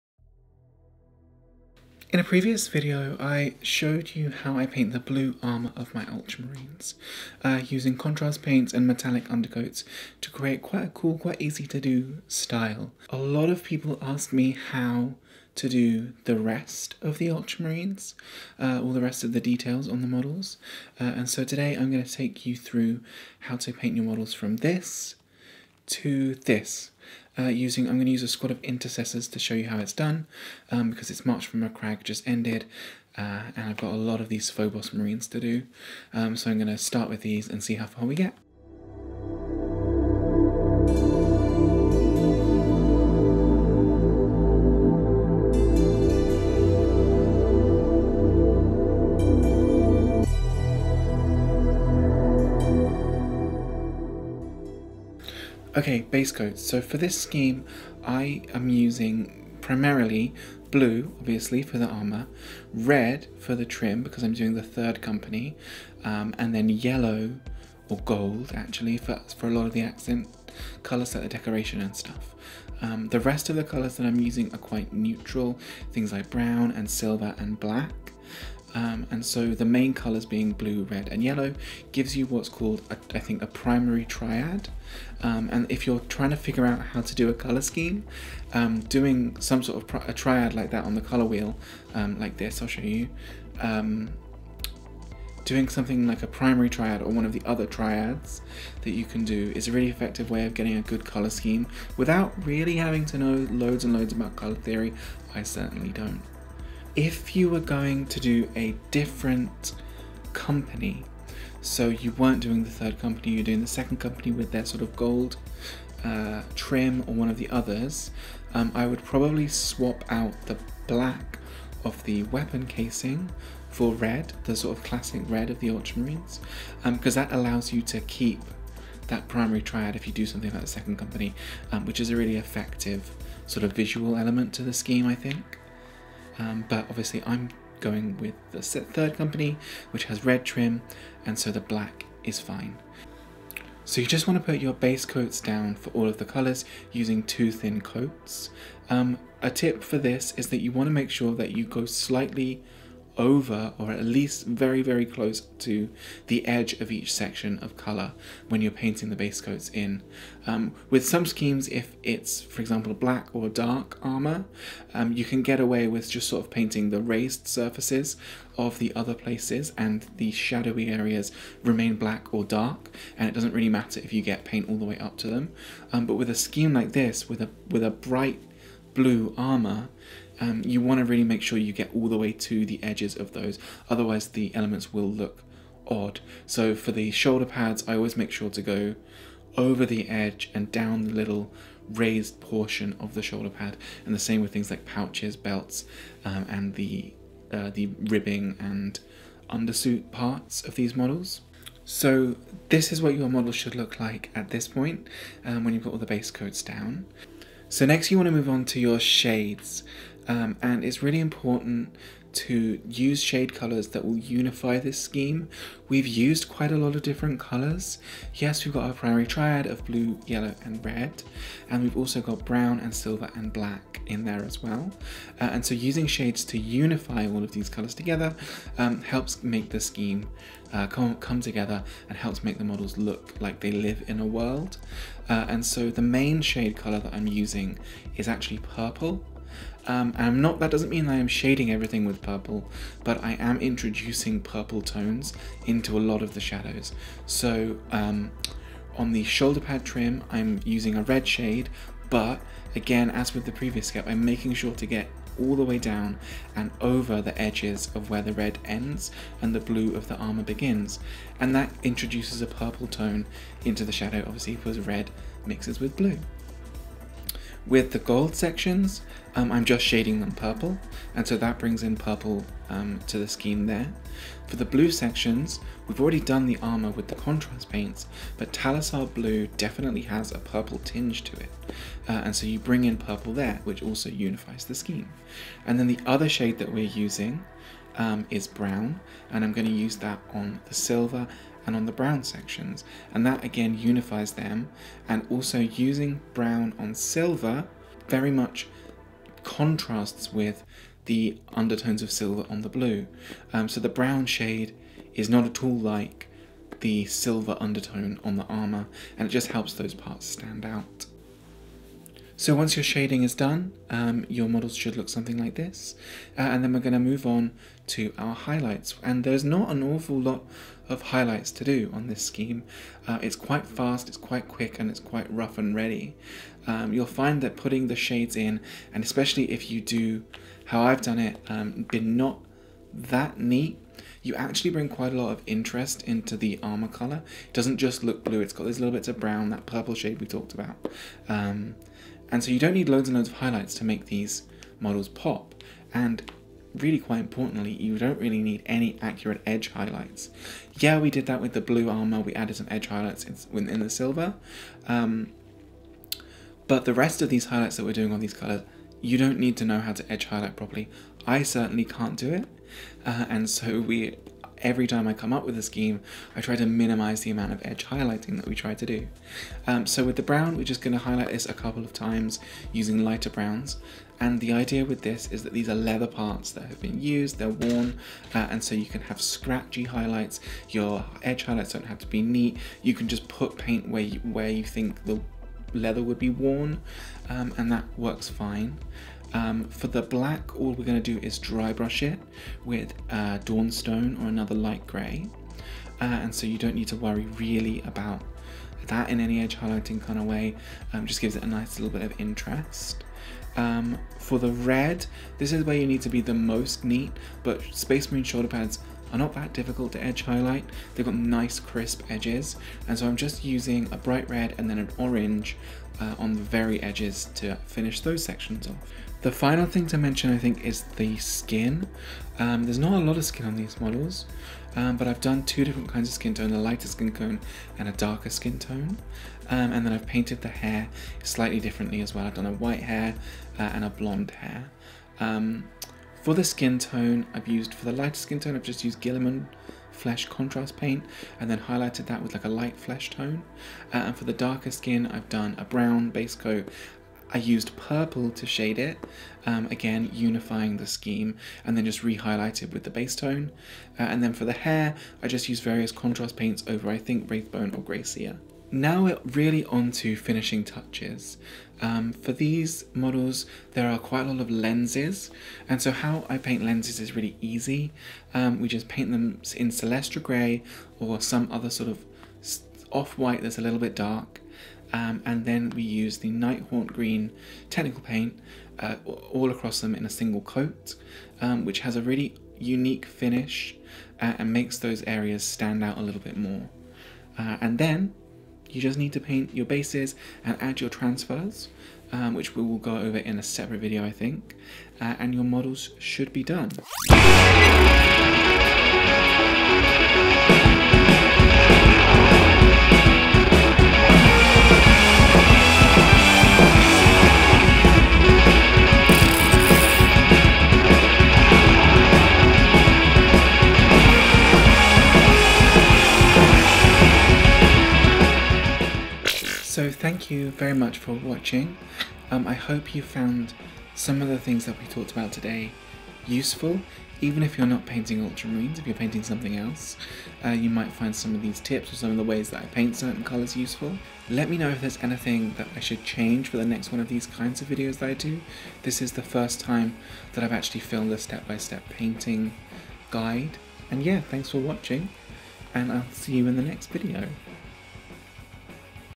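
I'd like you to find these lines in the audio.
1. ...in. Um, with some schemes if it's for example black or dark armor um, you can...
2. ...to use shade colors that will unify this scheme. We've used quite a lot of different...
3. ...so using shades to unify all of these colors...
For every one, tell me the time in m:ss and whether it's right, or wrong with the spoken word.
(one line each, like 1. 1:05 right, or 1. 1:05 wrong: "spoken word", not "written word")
1. 2:39 right
2. 3:32 right
3. 3:45 right.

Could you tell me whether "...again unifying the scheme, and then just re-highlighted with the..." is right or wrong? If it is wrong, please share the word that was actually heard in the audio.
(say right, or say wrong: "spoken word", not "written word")
right.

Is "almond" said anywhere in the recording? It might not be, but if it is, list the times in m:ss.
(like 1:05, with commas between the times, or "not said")
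not said.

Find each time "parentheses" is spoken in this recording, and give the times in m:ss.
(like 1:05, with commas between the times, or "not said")
not said.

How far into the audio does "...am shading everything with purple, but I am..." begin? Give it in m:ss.
4:01.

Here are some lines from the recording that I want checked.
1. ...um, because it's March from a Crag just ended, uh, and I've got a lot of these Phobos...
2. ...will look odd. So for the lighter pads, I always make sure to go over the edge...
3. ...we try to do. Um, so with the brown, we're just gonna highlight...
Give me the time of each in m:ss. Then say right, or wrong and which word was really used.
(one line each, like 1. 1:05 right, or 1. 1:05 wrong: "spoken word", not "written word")
1. 0:30 right
2. 3:04 wrong: "shoulder", not "lighter"
3. 6:08 right.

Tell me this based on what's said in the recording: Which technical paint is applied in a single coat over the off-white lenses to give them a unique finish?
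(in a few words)
Nighthaunt Green.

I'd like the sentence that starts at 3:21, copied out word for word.
So this is what your model should look like at this point um, when you've got all the base coats down.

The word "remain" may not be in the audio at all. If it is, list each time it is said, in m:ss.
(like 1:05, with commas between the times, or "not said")
2:51.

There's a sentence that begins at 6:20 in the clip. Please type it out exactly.
Your edge highlights don't have to be neat.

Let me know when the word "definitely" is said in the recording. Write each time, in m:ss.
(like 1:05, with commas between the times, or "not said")
4:39.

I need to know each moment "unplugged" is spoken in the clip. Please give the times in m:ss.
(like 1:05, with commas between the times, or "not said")
not said.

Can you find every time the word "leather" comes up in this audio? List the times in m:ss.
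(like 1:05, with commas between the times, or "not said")
6:15, 6:25.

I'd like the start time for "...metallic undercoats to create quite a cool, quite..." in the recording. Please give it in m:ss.
0:08.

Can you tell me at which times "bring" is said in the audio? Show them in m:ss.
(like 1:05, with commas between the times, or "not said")
4:31, 4:42, 5:34.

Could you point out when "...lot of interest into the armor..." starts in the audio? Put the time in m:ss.
5:35.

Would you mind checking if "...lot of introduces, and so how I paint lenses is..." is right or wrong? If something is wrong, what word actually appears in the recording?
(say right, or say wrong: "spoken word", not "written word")
wrong: "lenses", not "introduces".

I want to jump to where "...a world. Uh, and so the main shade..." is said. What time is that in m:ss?
3:54.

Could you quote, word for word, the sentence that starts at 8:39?
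So thank you very much for watching.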